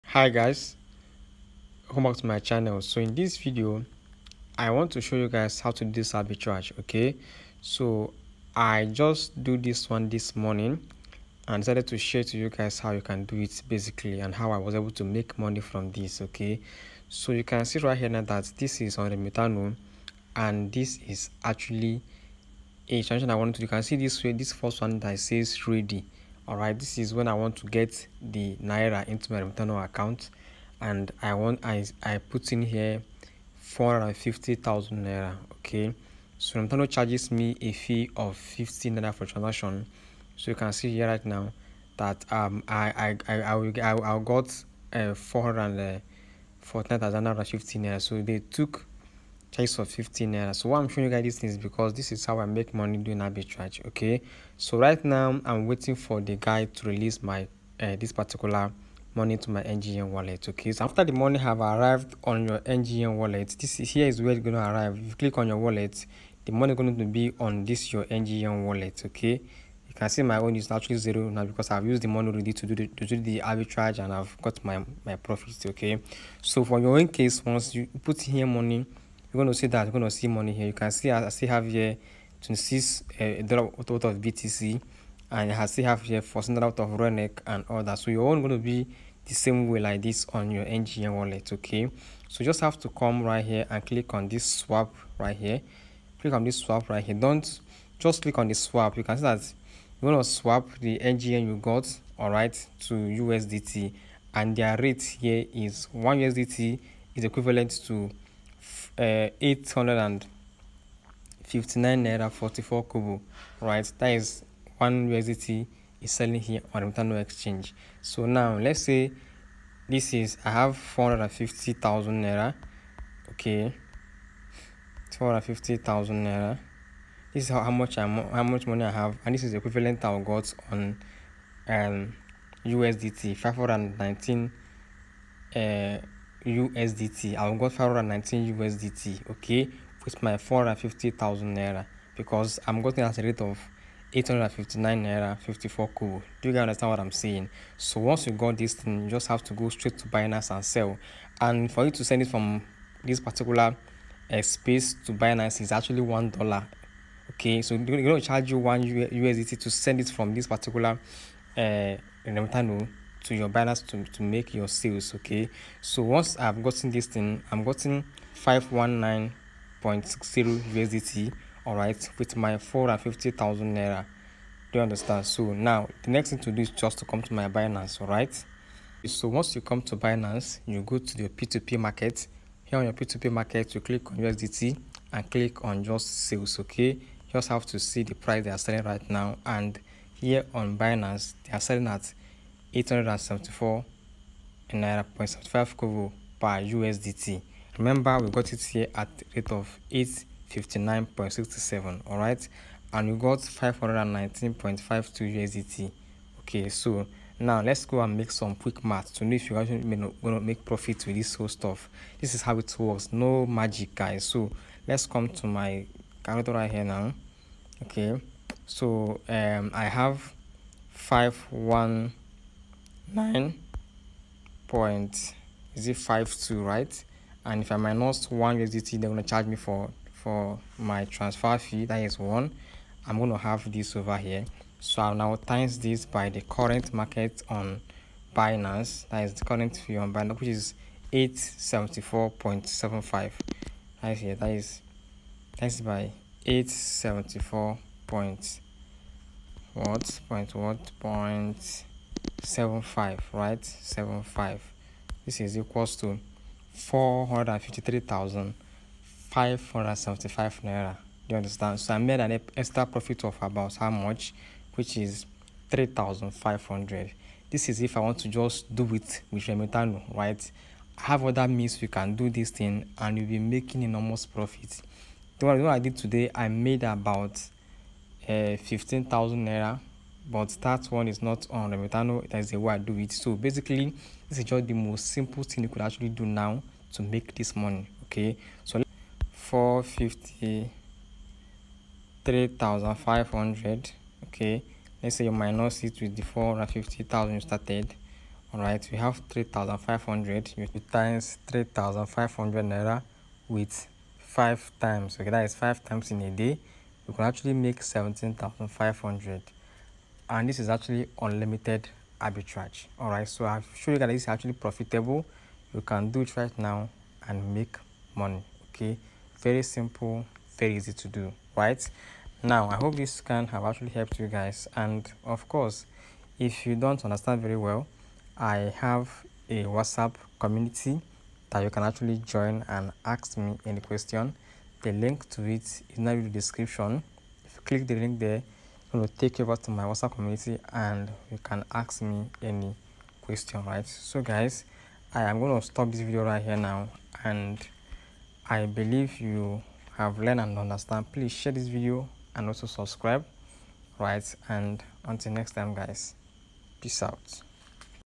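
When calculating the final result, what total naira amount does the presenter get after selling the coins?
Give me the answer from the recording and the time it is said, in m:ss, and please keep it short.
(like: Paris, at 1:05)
453,575 naira, at 4:16.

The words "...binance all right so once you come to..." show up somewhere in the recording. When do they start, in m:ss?
2:57.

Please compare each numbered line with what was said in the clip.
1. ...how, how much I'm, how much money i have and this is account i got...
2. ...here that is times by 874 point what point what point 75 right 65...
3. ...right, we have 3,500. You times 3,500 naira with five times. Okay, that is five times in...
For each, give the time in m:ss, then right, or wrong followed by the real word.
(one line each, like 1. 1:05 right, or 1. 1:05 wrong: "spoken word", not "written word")
1. 2:07 wrong: "equivalent", not "account"
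2. 4:04 wrong: "75", not "65"
3. 4:58 right.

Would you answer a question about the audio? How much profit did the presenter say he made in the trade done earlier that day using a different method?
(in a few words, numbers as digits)
15,000 naira.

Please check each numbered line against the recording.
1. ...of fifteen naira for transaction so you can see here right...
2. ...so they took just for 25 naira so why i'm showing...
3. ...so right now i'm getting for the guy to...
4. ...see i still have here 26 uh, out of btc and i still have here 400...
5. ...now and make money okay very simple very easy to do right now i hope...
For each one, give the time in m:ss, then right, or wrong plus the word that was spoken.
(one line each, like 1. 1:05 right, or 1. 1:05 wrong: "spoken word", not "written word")
1. 0:38 right
2. 0:48 wrong: "15", not "25"
3. 0:54 wrong: "waiting", not "getting"
4. 1:20 right
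5. 5:16 right.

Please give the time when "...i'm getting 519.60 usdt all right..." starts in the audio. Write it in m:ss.
2:47.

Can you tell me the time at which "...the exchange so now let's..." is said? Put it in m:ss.
1:56.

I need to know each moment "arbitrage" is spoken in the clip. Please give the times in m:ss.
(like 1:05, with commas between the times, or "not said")
0:06, 0:53, 1:13, 5:12.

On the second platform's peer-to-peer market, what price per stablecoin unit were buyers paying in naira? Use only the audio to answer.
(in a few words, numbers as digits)
874.75 naira.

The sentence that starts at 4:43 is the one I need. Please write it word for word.
So basically, this is just the most simple thing you could actually do now to make this money.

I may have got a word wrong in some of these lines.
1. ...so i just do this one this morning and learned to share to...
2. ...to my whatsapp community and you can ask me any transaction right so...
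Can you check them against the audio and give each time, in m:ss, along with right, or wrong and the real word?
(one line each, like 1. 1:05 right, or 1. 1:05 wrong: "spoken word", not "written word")
1. 0:07 wrong: "decided", not "learned"
2. 5:39 wrong: "question", not "transaction".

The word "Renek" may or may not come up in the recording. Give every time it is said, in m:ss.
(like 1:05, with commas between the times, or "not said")
1:26.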